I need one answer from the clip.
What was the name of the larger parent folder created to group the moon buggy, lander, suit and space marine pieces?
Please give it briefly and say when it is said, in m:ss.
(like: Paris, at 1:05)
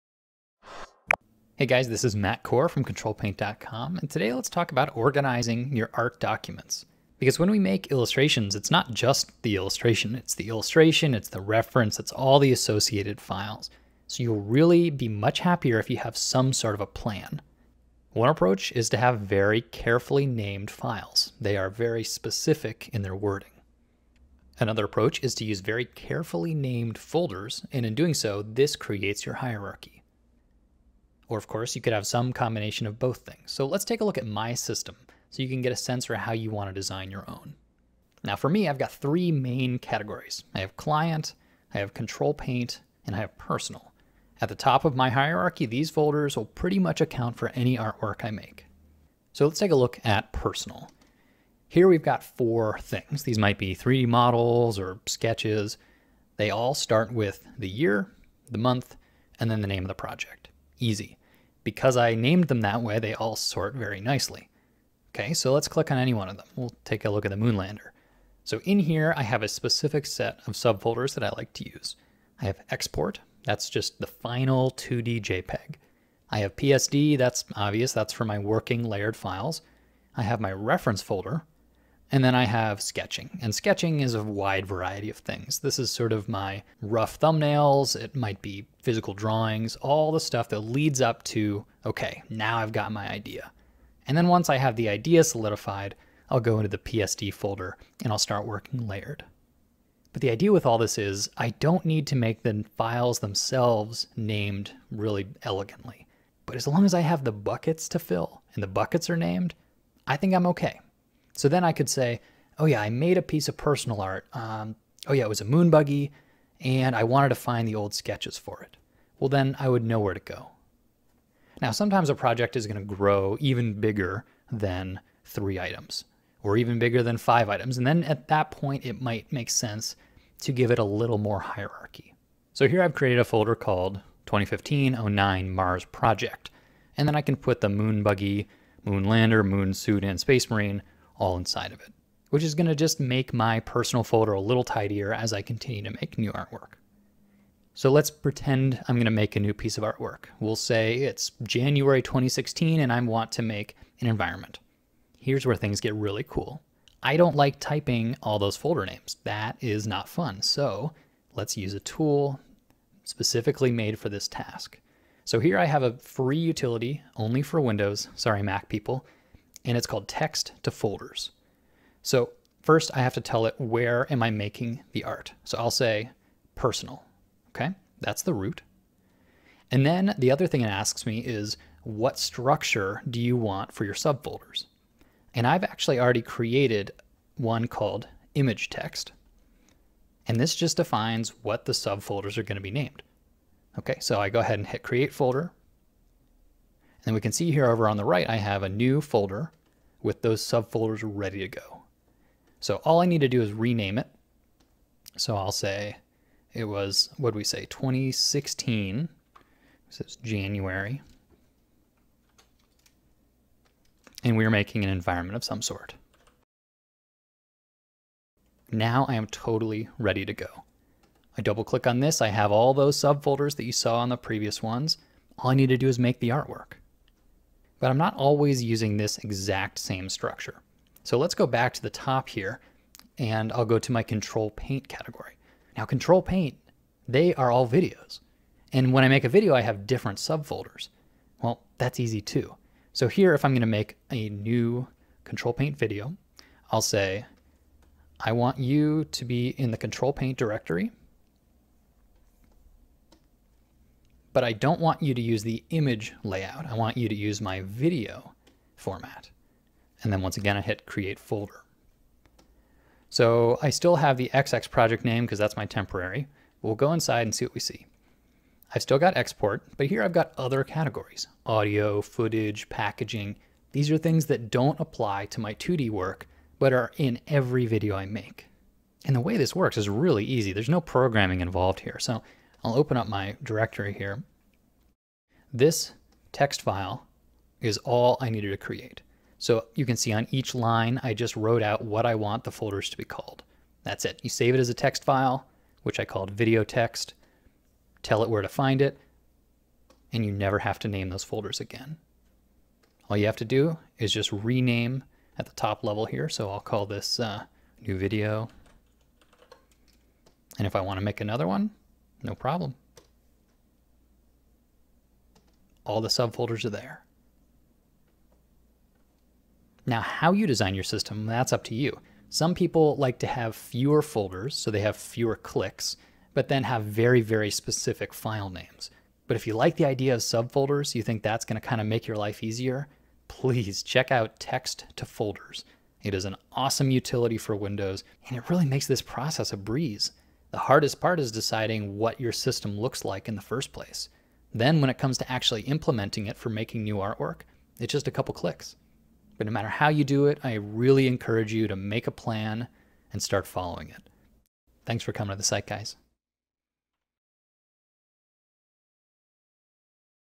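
2015-09 Mars Project, at 2:14.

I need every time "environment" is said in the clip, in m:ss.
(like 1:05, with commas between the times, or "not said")
2:34, 3:34.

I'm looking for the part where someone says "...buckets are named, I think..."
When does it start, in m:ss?
1:48.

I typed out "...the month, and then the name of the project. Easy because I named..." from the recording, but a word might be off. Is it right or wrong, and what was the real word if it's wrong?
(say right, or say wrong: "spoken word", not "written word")
right.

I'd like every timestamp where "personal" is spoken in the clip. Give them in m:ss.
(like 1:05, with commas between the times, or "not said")
0:43, 0:50, 1:53, 2:23, 2:56.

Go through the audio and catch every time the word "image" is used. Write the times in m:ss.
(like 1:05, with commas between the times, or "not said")
3:08, 4:15.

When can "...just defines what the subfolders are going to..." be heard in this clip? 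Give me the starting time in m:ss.
3:10.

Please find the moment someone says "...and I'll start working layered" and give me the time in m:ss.
1:38.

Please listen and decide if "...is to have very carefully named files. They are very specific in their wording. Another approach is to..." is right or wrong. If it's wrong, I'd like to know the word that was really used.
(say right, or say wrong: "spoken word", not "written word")
right.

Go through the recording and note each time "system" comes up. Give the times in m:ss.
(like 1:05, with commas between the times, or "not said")
0:34, 5:20, 5:42.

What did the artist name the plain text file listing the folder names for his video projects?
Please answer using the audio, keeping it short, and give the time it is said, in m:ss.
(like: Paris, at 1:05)
video text, at 4:56.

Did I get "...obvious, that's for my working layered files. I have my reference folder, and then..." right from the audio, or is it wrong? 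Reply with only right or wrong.
right.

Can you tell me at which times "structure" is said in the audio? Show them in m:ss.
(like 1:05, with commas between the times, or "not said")
3:02, 3:50.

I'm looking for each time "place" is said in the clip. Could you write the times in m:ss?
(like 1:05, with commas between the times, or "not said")
5:43.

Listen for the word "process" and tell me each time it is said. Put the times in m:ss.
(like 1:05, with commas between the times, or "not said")
5:39.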